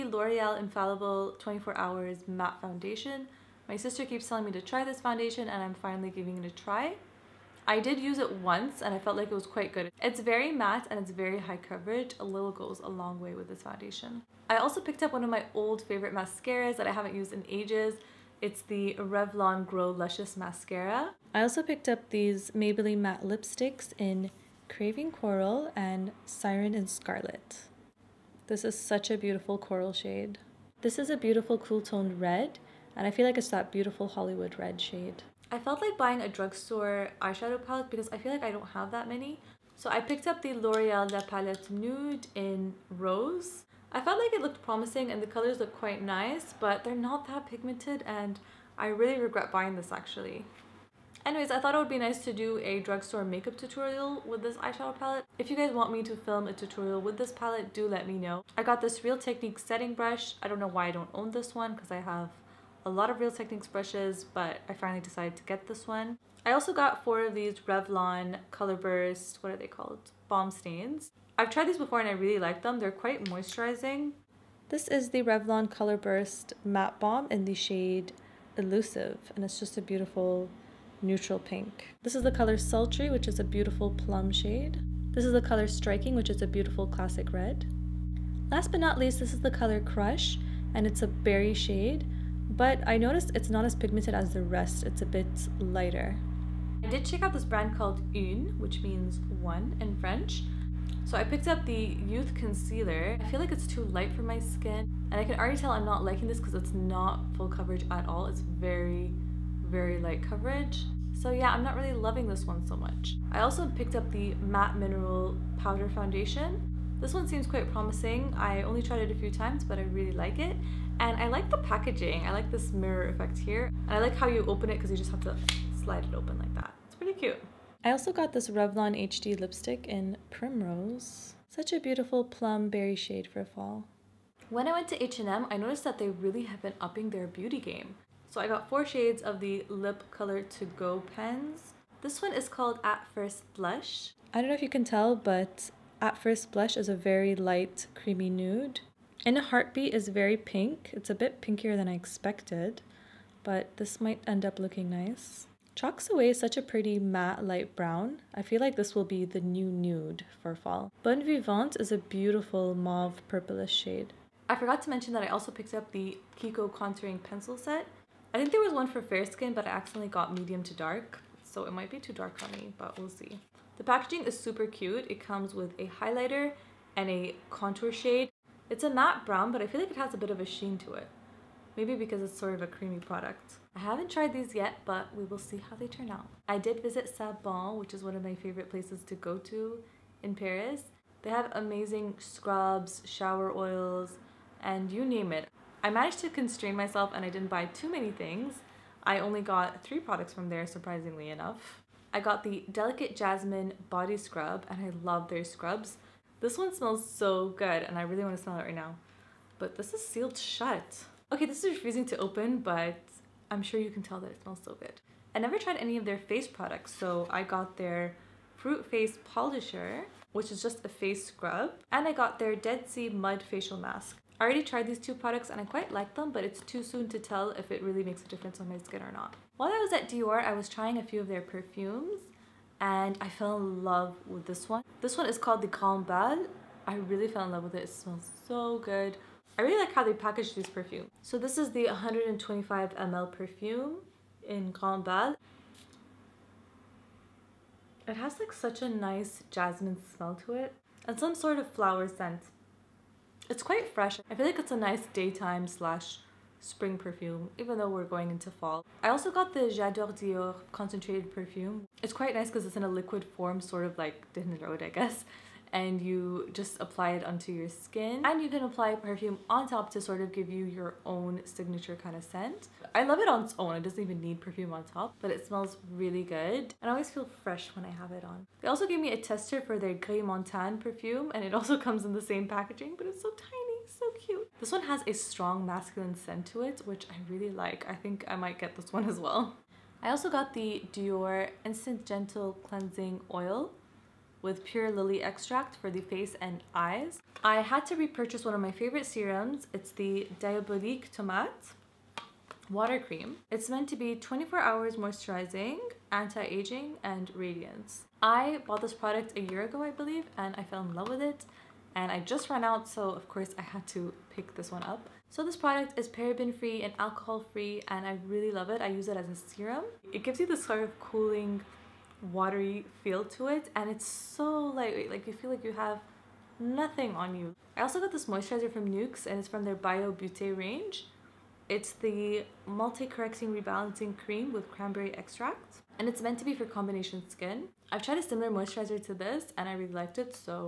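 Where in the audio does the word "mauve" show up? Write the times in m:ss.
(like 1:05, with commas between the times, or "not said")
2:42.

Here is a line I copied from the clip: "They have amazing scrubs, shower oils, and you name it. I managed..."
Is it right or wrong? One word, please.
right.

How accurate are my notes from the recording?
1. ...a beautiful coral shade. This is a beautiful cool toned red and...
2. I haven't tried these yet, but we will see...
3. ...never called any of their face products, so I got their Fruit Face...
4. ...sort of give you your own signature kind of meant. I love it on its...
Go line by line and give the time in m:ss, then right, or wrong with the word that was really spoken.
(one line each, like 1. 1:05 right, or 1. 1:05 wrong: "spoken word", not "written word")
1. 0:29 right
2. 3:03 right
3. 3:35 wrong: "tried", not "called"
4. 4:30 wrong: "scent", not "meant".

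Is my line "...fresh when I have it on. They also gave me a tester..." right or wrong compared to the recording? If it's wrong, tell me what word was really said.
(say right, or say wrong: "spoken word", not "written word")
right.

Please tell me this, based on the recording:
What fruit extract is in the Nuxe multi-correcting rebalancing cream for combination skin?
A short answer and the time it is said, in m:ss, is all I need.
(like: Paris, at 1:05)
cranberry, at 5:34.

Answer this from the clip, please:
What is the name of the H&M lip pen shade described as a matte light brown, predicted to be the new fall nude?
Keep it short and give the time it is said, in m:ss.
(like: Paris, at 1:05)
Chalks Away, at 2:35.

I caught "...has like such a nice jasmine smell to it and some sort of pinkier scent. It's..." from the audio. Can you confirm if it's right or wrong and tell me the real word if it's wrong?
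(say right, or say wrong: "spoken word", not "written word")
wrong: "flower", not "pinkier".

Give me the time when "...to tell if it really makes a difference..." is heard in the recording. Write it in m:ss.
3:47.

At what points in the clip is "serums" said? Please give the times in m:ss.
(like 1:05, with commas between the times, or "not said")
4:59, 5:19.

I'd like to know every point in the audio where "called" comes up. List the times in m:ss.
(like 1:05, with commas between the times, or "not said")
1:09, 1:37, 2:22, 3:55.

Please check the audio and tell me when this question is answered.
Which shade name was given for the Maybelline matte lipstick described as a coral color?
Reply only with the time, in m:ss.
0:24.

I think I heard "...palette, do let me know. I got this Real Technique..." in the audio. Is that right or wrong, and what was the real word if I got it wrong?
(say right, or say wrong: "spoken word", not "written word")
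right.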